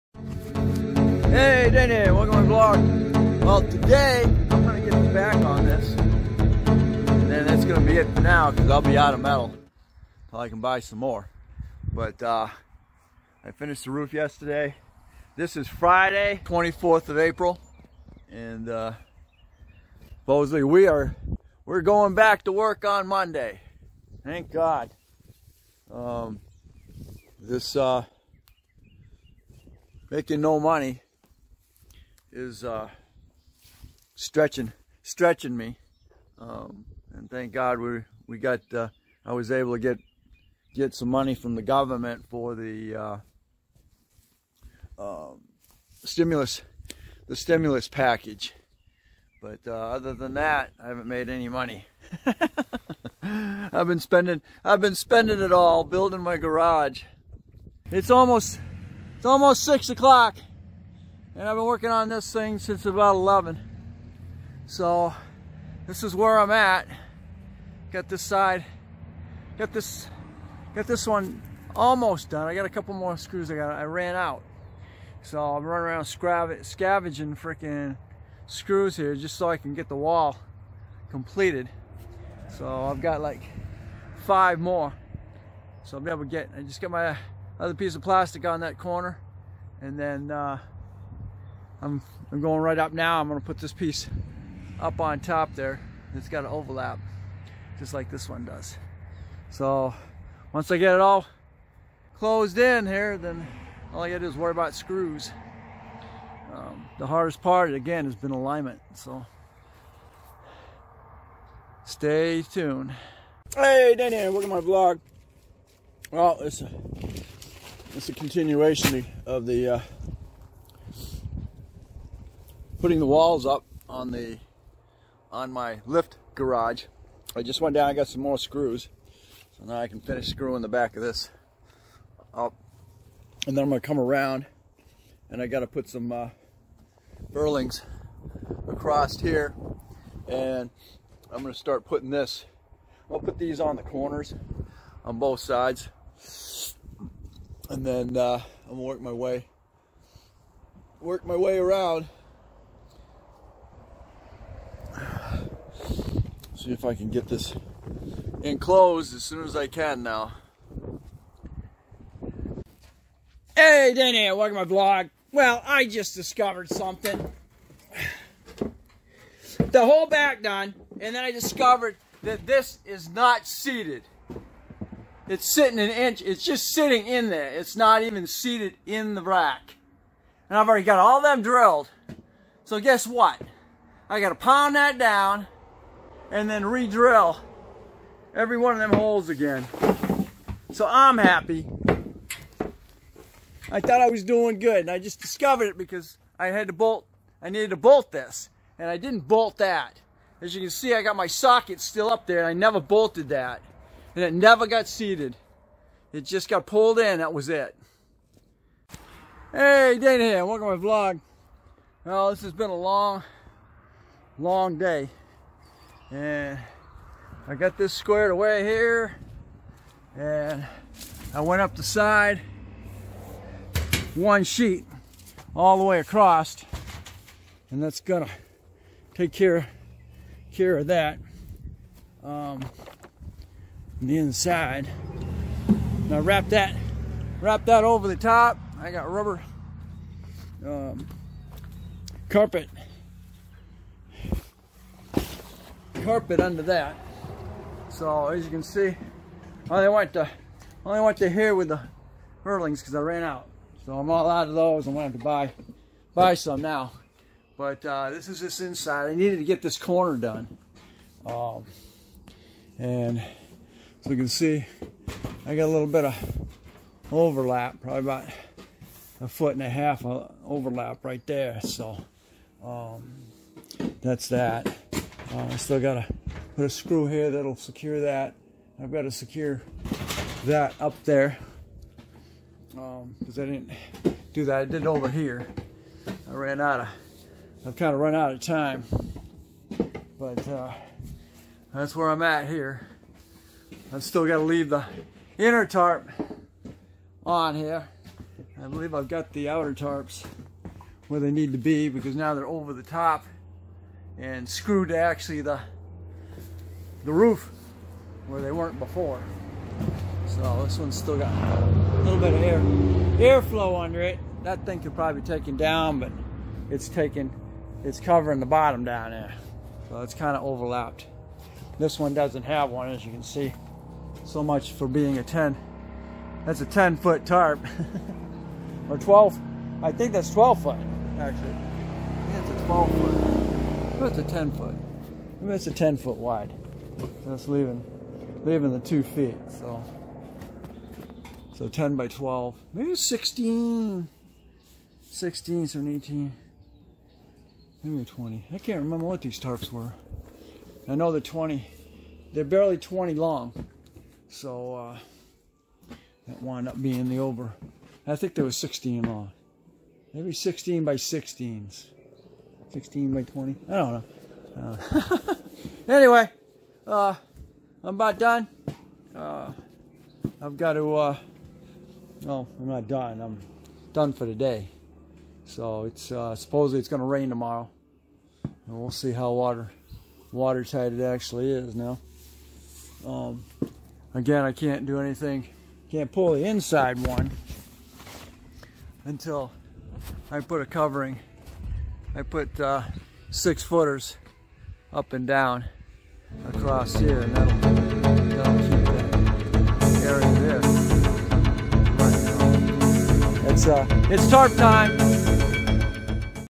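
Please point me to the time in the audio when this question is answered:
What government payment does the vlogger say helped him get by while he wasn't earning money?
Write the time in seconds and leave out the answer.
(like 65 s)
47 s.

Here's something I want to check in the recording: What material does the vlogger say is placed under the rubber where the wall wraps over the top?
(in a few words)
Carpet.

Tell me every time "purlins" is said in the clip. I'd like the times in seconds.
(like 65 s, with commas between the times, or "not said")
137 s, 252 s.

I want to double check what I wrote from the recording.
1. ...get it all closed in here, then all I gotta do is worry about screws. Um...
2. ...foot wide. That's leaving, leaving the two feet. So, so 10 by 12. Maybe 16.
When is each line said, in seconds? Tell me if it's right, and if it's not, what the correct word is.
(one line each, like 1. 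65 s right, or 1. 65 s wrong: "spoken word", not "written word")
1. 100 s right
2. 335 s right.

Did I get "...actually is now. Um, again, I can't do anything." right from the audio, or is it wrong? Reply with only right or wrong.
right.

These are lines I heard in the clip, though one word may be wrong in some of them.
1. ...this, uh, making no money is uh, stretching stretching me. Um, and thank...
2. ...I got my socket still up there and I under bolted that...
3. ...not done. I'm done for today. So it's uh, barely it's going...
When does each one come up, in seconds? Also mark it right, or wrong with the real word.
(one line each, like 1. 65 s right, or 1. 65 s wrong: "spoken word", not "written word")
1. 27 s right
2. 200 s wrong: "never", not "under"
3. 372 s wrong: "supposedly", not "barely".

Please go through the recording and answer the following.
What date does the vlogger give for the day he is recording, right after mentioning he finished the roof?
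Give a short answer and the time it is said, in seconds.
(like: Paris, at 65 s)
Friday, 24th of April, at 15 s.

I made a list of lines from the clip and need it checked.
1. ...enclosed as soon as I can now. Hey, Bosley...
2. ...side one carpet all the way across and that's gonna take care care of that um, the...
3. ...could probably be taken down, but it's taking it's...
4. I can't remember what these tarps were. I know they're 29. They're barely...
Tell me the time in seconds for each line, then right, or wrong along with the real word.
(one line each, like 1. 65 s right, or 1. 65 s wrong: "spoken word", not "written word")
1. 158 s wrong: "Dana", not "Bosley"
2. 221 s wrong: "sheet", not "carpet"
3. 314 s right
4. 348 s wrong: "20", not "29".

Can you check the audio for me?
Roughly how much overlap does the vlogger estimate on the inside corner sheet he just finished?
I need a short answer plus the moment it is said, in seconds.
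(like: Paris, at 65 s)
About a foot and a half, at 268 s.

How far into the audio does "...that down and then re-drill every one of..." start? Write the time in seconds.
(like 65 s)
184 s.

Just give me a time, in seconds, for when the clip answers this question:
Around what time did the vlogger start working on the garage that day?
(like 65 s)
62 s.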